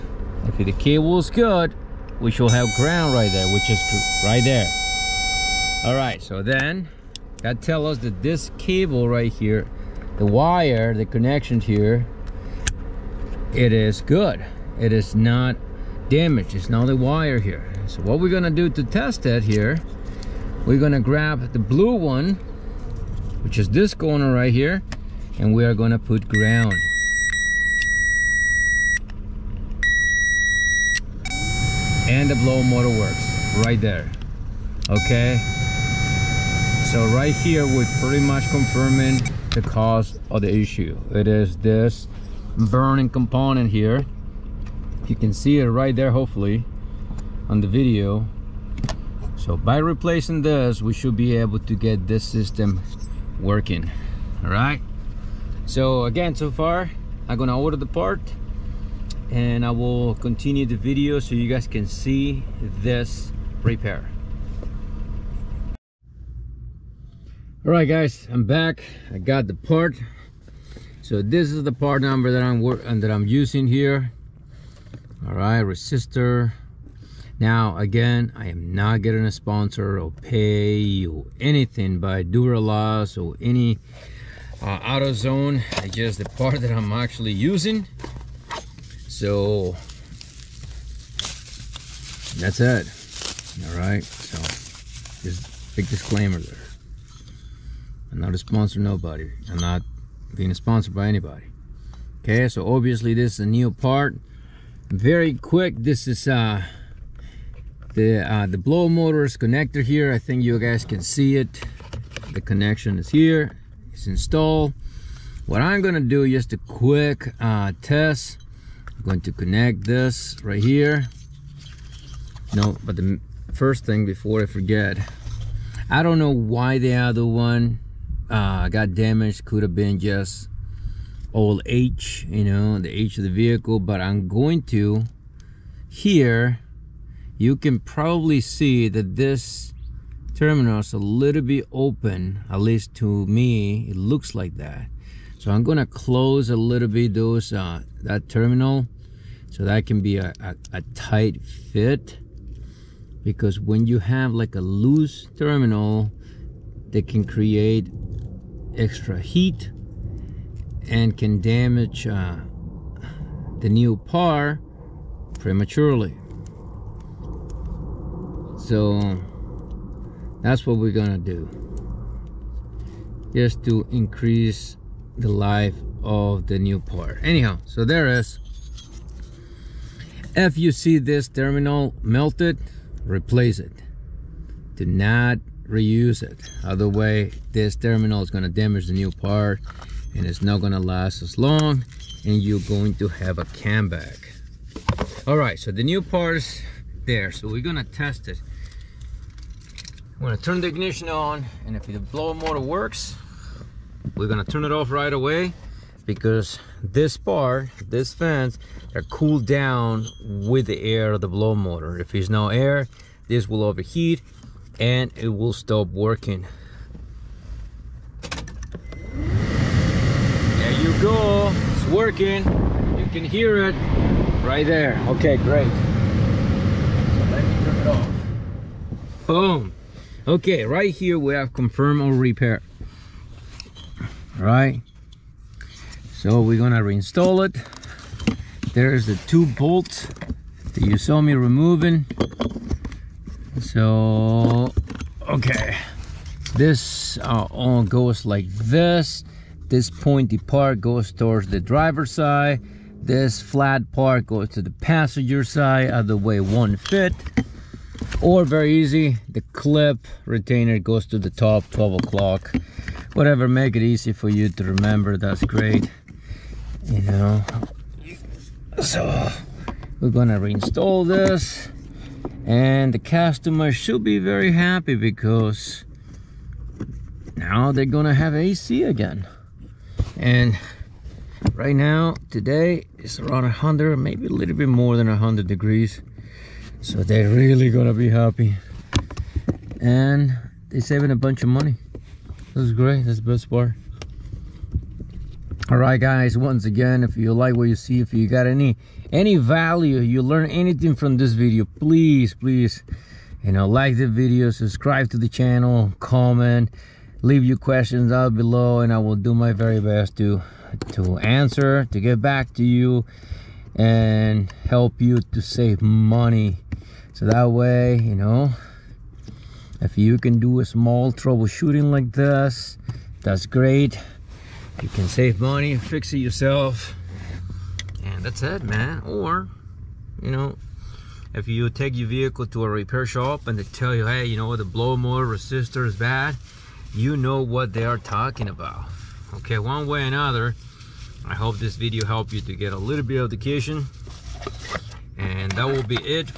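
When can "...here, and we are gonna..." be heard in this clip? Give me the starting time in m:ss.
0:24.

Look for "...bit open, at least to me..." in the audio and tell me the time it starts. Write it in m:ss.
2:21.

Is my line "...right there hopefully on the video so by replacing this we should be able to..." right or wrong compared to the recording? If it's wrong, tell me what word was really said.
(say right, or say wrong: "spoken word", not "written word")
right.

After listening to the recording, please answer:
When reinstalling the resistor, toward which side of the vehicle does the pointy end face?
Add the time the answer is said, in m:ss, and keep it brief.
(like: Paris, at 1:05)
Driver's side, at 4:11.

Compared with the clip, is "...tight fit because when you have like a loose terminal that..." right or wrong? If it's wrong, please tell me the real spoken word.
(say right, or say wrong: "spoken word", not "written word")
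right.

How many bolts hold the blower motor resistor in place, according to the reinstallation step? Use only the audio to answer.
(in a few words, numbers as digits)
2.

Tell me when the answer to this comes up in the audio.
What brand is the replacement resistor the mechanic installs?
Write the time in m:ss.
1:22.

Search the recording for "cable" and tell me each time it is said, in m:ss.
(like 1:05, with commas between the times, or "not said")
0:00, 0:08.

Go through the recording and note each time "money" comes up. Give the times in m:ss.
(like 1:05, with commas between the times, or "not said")
4:51, 5:15, 5:25.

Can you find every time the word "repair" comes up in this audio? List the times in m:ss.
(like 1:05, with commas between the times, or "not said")
1:03, 3:52, 5:32.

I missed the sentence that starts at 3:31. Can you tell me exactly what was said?
If there's no air, this will overheat and it will stop working.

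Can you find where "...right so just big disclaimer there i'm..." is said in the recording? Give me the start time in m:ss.
1:33.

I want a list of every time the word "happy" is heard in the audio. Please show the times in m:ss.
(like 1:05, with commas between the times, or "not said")
4:34, 4:48.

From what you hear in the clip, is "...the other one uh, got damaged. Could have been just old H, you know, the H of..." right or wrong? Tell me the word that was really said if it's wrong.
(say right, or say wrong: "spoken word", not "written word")
right.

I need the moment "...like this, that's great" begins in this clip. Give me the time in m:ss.
5:21.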